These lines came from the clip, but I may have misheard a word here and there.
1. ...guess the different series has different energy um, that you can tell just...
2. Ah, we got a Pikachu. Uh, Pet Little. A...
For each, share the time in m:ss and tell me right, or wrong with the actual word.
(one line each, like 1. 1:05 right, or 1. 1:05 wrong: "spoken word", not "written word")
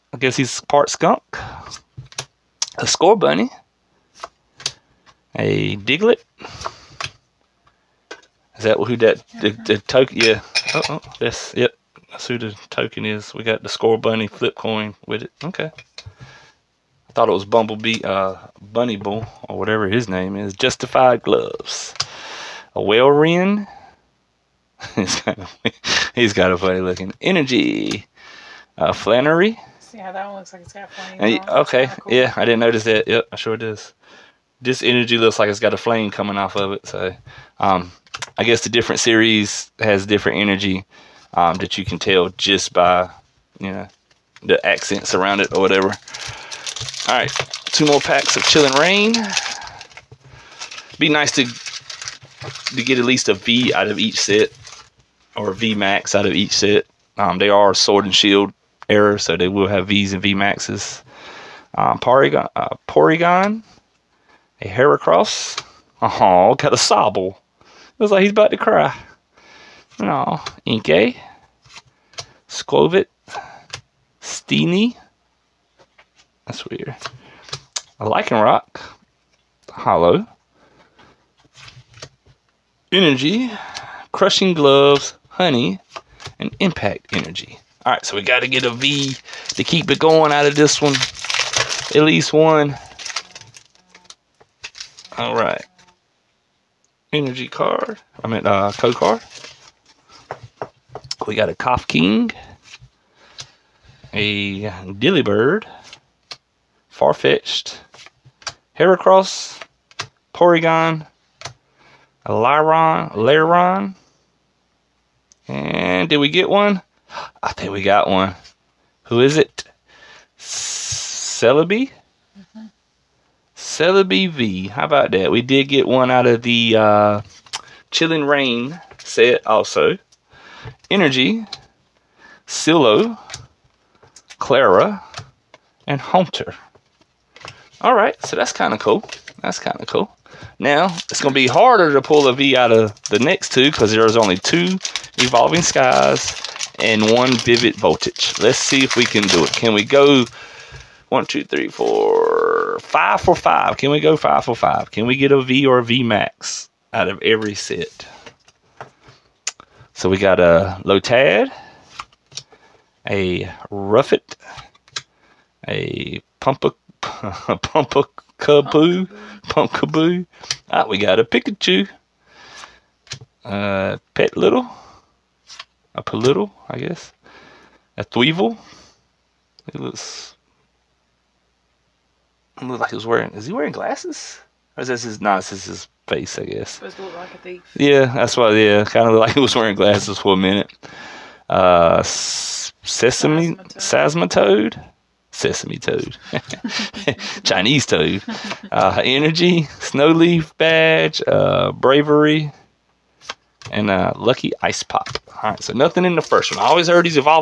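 1. 0:38 right
2. 2:50 right.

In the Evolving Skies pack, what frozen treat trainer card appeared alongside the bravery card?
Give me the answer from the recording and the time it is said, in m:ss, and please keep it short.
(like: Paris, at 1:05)
lucky ice pop, at 3:24.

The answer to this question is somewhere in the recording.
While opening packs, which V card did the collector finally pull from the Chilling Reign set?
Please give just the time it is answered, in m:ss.
2:03.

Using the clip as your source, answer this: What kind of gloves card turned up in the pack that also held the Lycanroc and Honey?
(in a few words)
Crushing Gloves.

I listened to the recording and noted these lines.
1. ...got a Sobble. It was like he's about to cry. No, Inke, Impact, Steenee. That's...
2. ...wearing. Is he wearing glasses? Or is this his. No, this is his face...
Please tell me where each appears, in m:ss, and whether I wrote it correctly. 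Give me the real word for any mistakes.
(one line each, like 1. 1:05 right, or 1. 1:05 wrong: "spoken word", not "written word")
1. 1:06 wrong: "Scovit", not "Impact"
2. 3:03 right.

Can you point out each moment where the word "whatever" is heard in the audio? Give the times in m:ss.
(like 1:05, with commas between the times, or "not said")
0:19, 0:45.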